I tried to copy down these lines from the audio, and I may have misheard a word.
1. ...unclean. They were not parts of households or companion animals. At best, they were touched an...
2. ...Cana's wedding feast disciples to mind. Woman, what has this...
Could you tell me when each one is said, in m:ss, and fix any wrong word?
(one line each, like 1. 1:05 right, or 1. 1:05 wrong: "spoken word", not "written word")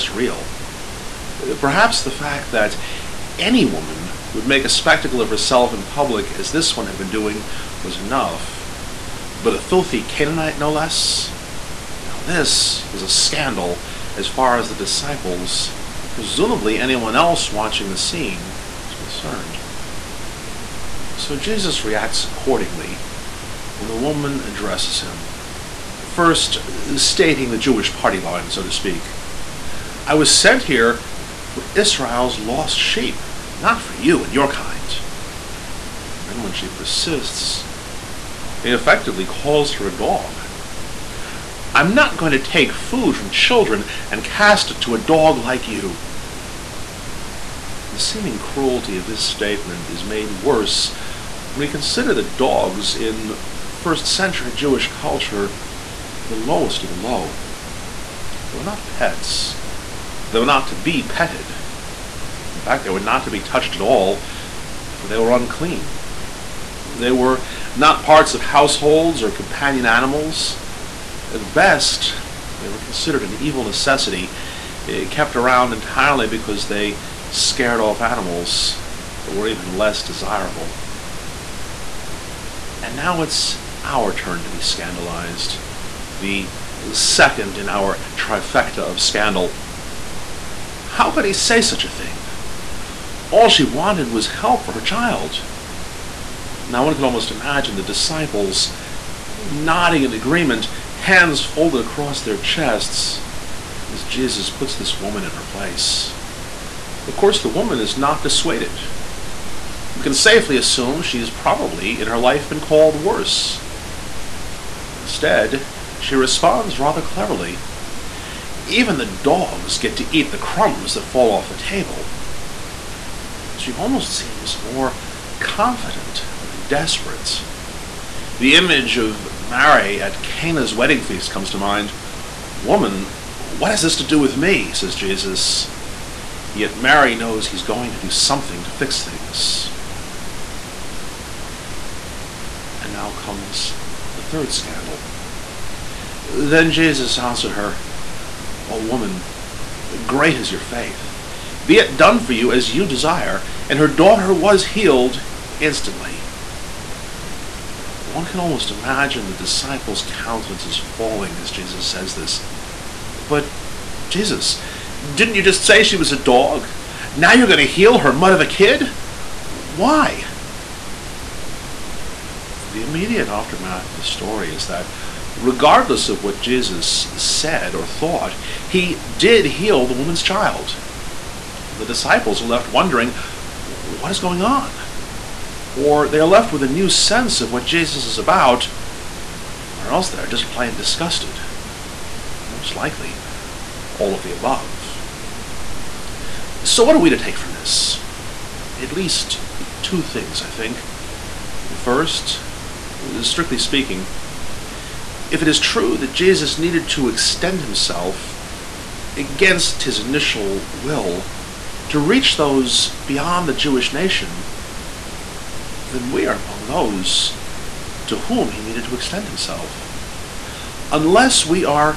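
1. 1:05 wrong: "considered", not "touched"
2. 2:10 wrong: "comes", not "disciples".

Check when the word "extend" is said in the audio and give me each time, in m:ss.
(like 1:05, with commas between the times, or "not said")
3:27, 3:38.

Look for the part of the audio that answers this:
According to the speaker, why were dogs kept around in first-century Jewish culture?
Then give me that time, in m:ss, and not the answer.
1:17.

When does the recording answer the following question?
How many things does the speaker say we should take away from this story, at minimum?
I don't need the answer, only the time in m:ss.
3:19.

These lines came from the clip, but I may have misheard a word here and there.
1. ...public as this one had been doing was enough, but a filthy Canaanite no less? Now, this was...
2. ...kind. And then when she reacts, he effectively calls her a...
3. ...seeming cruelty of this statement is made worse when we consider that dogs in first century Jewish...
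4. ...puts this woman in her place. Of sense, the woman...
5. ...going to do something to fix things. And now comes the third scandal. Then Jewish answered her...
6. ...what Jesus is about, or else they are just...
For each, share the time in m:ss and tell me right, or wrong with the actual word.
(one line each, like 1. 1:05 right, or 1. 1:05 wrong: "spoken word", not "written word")
1. 0:05 right
2. 0:34 wrong: "persists", not "reacts"
3. 0:47 right
4. 1:44 wrong: "course", not "sense"
5. 2:17 wrong: "Jesus", not "Jewish"
6. 3:07 right.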